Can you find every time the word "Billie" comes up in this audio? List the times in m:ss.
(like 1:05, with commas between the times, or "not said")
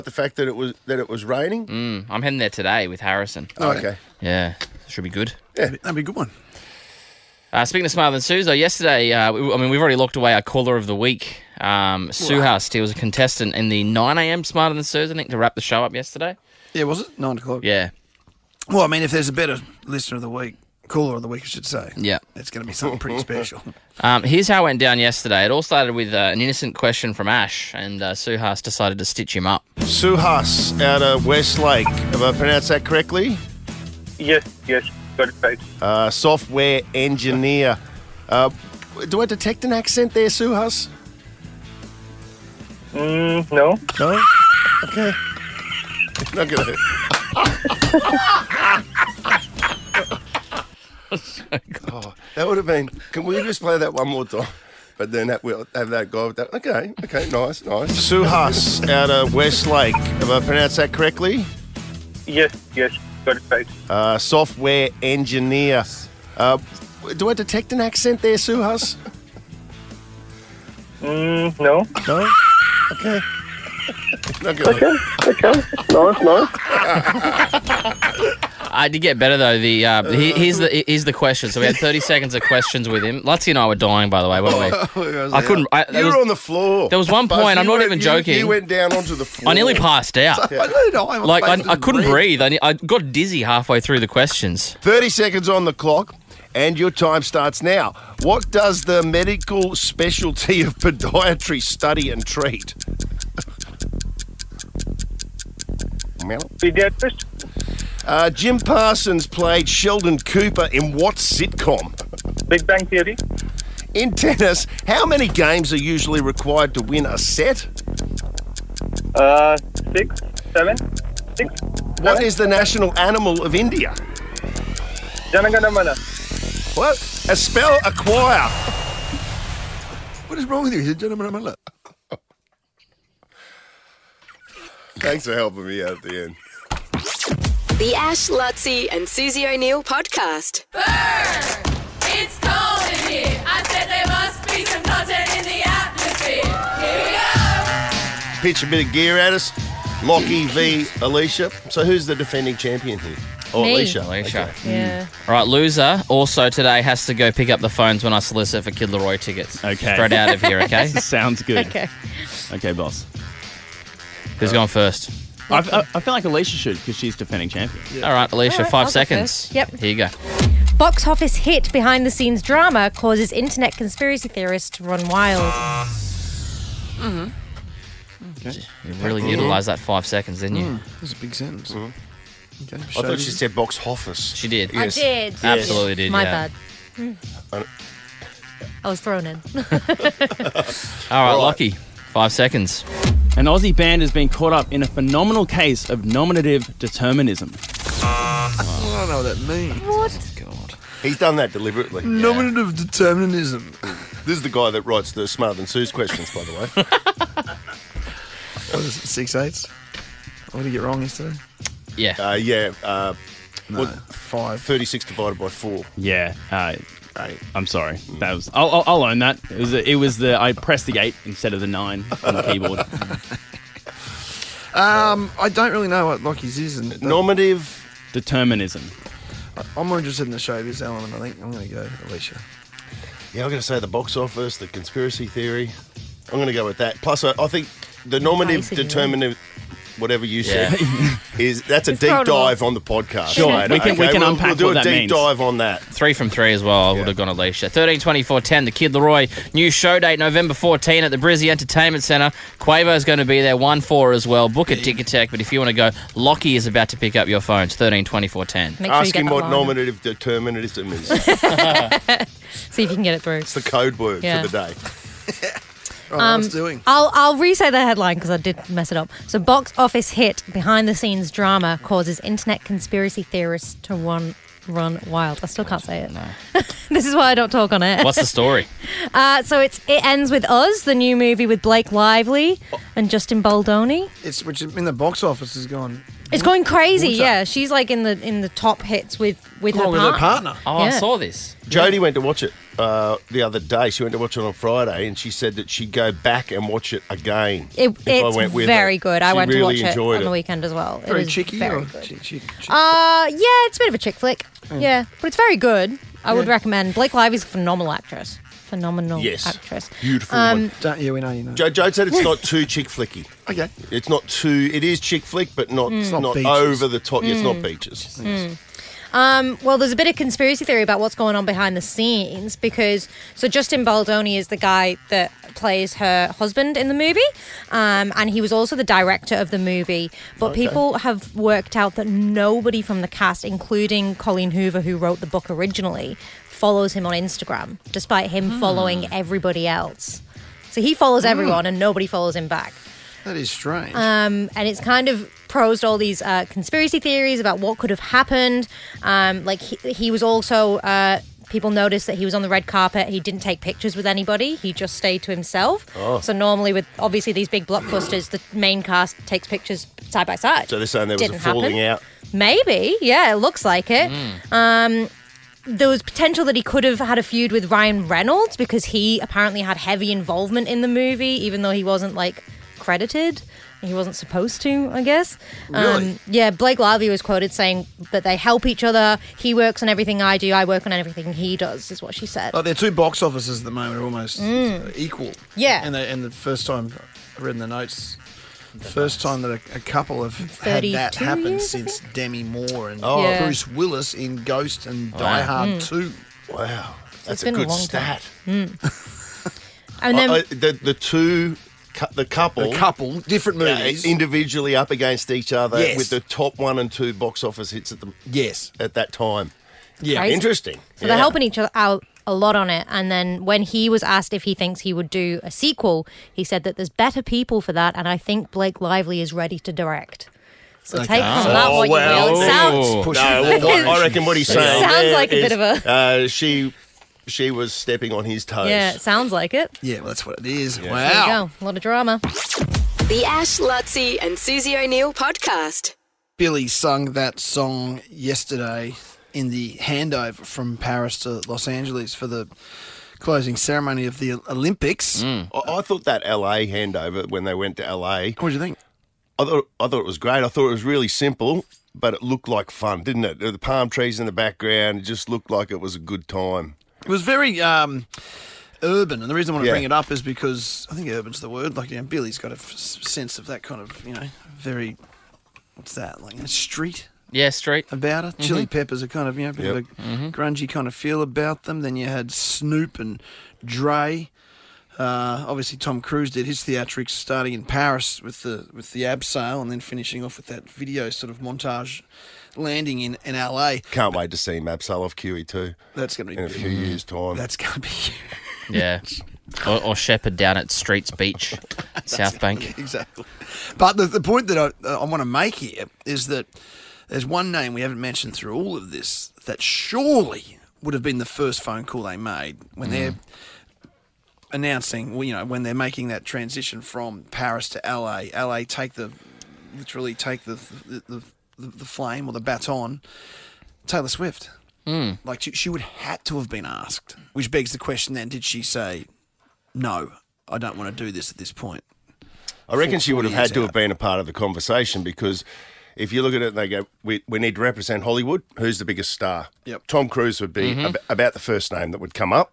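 7:16, 7:42.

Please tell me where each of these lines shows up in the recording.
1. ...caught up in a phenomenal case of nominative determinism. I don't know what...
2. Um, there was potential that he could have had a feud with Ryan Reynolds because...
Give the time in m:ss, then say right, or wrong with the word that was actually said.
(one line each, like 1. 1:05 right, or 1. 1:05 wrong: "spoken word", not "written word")
1. 3:14 right
2. 6:05 right.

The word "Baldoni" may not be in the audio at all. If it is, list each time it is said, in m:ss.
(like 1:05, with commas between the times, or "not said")
4:43, 5:23.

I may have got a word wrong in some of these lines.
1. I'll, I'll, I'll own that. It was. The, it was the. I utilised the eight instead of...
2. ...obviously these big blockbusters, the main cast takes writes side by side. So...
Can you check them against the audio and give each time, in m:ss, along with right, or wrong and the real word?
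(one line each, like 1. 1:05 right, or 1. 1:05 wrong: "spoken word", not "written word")
1. 3:38 wrong: "pressed", not "utilised"
2. 5:56 wrong: "pictures", not "writes".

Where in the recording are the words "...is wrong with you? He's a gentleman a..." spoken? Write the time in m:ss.
2:10.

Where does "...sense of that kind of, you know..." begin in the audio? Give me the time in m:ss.
7:42.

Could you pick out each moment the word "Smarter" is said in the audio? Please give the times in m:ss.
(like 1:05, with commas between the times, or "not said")
0:07, 0:14, 3:25.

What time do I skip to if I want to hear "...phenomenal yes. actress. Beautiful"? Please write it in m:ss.
5:08.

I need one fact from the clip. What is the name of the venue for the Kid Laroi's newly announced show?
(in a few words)
Brizzy Entertainment Centre.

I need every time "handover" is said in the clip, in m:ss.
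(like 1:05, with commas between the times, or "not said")
7:19, 7:26.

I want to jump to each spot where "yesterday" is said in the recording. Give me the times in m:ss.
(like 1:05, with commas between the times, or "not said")
0:08, 0:15, 0:25, 3:31, 7:18.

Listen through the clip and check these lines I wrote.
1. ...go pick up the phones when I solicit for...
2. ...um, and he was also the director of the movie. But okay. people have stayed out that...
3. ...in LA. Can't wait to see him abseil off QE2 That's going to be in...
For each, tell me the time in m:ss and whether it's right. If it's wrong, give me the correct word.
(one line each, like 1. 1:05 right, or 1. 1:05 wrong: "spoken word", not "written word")
1. 2:37 right
2. 5:27 wrong: "worked", not "stayed"
3. 8:03 right.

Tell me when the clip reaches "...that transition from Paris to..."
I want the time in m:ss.
8:26.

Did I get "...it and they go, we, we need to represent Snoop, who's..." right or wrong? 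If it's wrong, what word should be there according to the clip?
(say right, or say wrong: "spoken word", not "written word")
wrong: "Hollywood", not "Snoop".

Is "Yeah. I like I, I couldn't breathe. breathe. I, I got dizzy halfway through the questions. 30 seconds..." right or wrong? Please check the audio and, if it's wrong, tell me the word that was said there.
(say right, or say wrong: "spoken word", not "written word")
right.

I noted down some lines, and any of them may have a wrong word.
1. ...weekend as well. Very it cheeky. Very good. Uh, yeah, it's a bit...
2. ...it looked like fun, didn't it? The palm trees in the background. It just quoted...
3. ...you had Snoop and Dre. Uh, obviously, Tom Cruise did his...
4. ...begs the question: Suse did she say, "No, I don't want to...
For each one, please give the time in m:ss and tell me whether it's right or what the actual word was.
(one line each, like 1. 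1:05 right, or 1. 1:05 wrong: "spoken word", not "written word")
1. 5:00 right
2. 7:32 wrong: "looked", not "quoted"
3. 7:51 right
4. 8:37 wrong: "Then", not "Suse".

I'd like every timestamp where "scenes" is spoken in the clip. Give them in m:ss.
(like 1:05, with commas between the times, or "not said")
2:52, 4:30, 5:21.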